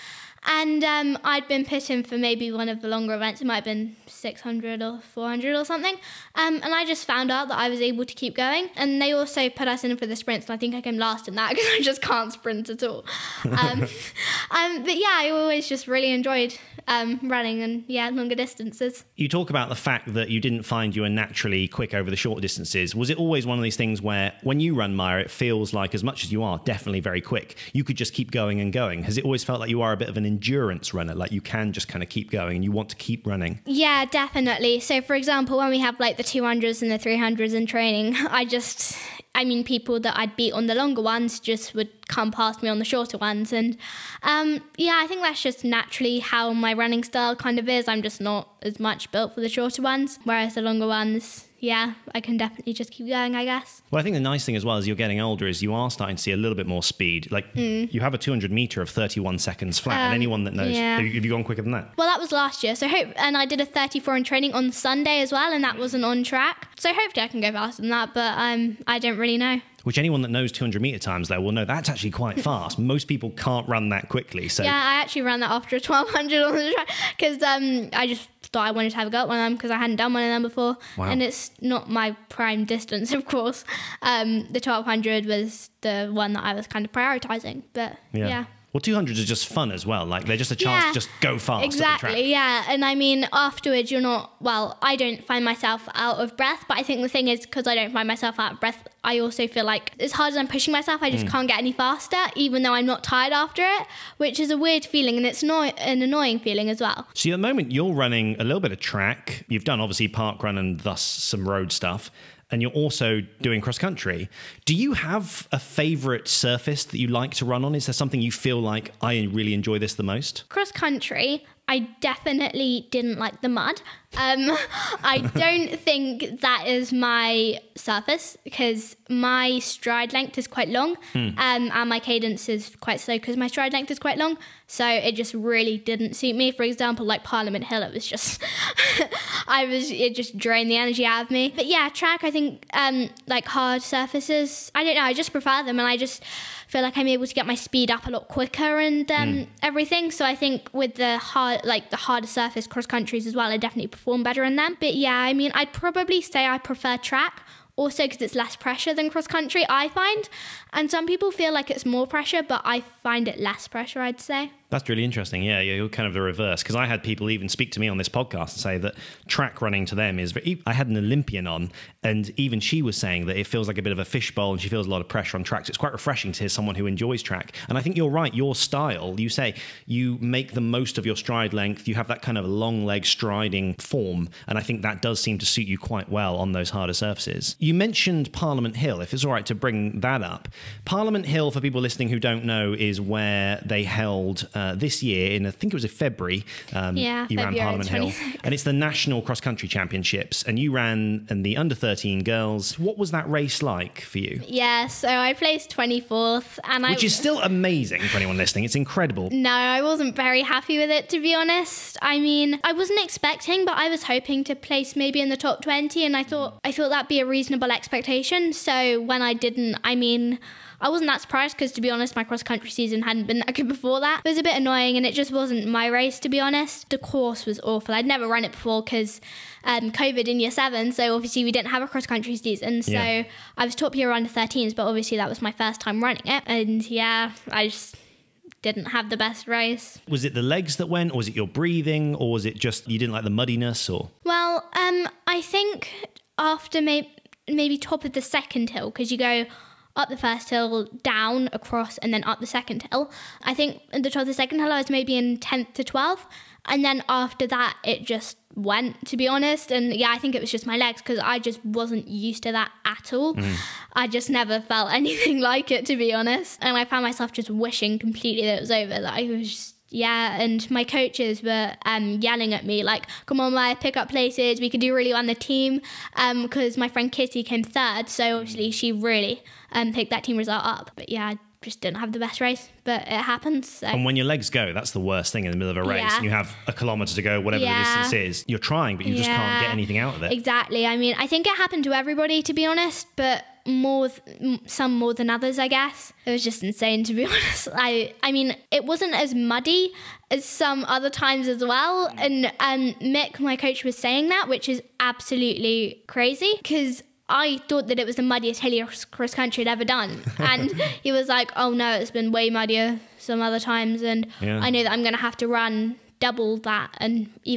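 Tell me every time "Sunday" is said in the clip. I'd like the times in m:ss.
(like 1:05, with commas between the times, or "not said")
1:04.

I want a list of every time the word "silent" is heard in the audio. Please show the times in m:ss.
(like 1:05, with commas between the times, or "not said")
not said.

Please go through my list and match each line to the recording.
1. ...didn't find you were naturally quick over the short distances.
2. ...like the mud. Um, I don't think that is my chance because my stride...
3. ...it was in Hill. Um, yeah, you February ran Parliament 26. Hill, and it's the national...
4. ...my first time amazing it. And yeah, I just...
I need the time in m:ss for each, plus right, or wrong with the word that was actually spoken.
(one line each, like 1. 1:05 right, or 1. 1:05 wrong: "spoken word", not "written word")
1. 0:20 right
2. 2:03 wrong: "surface", not "chance"
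3. 3:15 wrong: "February", not "Hill"
4. 3:55 wrong: "running", not "amazing".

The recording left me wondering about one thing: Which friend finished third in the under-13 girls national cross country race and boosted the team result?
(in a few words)
Kitty.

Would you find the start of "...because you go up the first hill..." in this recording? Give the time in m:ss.
4:08.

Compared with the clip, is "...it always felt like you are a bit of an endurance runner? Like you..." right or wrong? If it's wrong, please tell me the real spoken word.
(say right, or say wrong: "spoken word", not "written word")
right.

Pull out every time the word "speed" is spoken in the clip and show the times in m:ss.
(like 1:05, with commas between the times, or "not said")
0:56, 2:27.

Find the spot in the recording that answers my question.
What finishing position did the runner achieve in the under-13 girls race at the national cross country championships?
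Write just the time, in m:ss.
3:25.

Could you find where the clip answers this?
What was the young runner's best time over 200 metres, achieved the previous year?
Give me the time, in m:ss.
0:58.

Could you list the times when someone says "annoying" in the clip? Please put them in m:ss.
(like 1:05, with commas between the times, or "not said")
1:46, 3:44.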